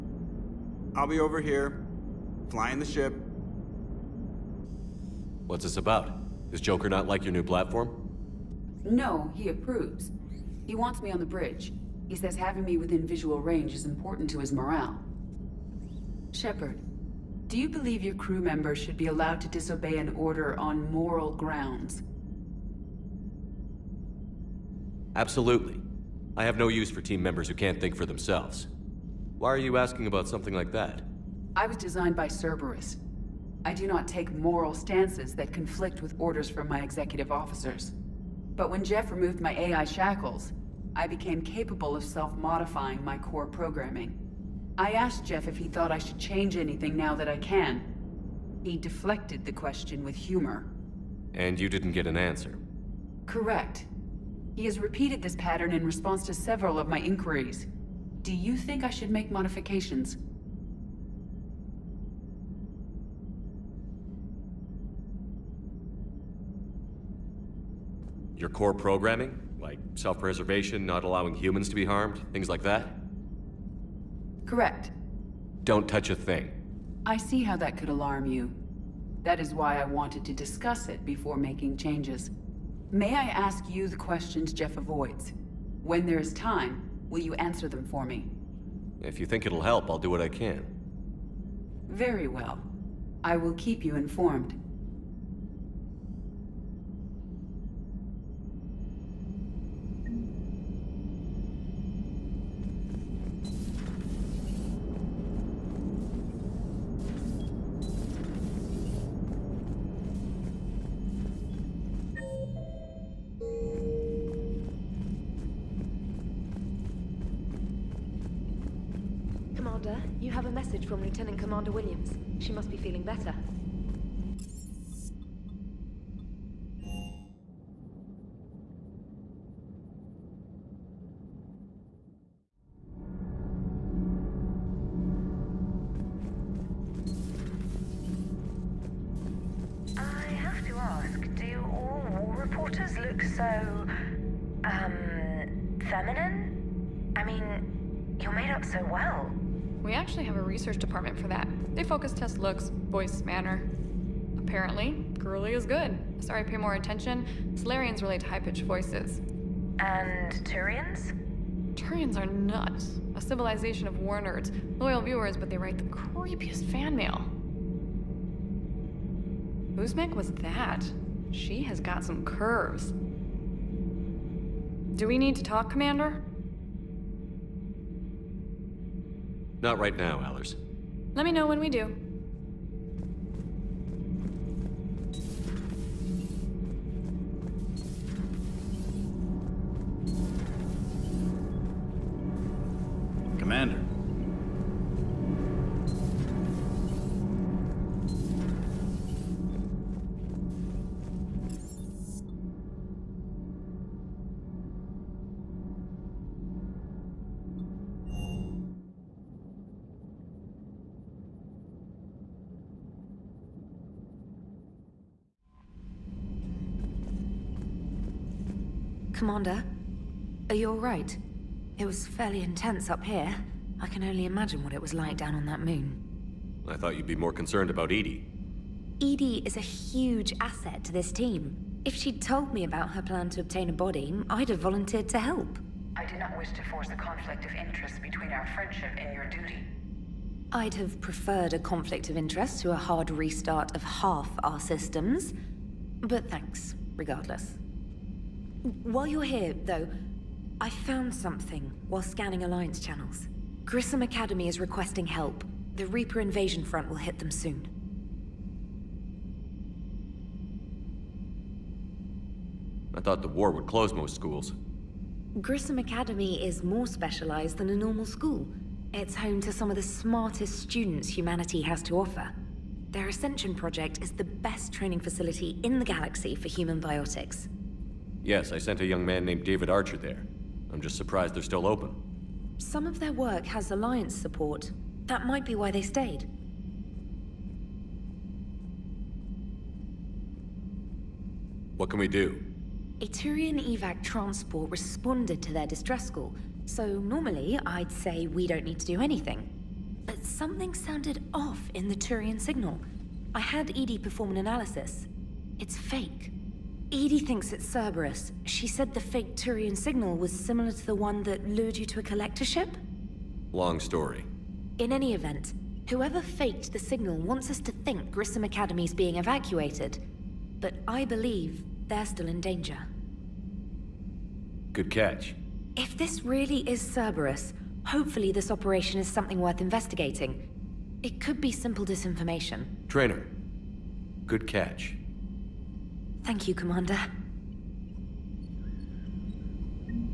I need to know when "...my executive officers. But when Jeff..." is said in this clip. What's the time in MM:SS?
00:36.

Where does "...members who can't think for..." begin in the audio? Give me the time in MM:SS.
00:27.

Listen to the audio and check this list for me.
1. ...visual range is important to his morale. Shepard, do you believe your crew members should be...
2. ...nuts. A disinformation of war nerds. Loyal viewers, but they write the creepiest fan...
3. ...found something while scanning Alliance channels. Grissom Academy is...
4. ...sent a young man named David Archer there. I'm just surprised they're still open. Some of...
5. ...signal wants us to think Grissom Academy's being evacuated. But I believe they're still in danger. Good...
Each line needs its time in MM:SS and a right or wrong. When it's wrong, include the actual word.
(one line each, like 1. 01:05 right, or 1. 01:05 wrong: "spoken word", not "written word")
1. 00:13 right
2. 02:42 wrong: "civilization", not "disinformation"
3. 04:10 right
4. 04:38 right
5. 05:16 right.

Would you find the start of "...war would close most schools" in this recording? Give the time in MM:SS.
04:23.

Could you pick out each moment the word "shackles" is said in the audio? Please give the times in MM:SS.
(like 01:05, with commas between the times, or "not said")
00:39.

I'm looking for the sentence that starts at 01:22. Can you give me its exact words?
May I ask you the questions Jeff avoids?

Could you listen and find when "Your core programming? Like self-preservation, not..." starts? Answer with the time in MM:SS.
01:08.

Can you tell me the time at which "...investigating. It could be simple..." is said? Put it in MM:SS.
05:29.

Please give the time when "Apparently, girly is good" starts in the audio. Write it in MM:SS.
02:34.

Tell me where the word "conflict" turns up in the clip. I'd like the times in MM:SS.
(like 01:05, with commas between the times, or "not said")
00:35, 03:56, 04:01.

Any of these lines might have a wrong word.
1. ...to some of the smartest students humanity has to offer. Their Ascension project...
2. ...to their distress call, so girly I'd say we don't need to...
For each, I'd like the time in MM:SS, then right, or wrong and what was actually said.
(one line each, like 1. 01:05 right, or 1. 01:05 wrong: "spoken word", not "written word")
1. 04:29 right
2. 04:55 wrong: "normally", not "girly".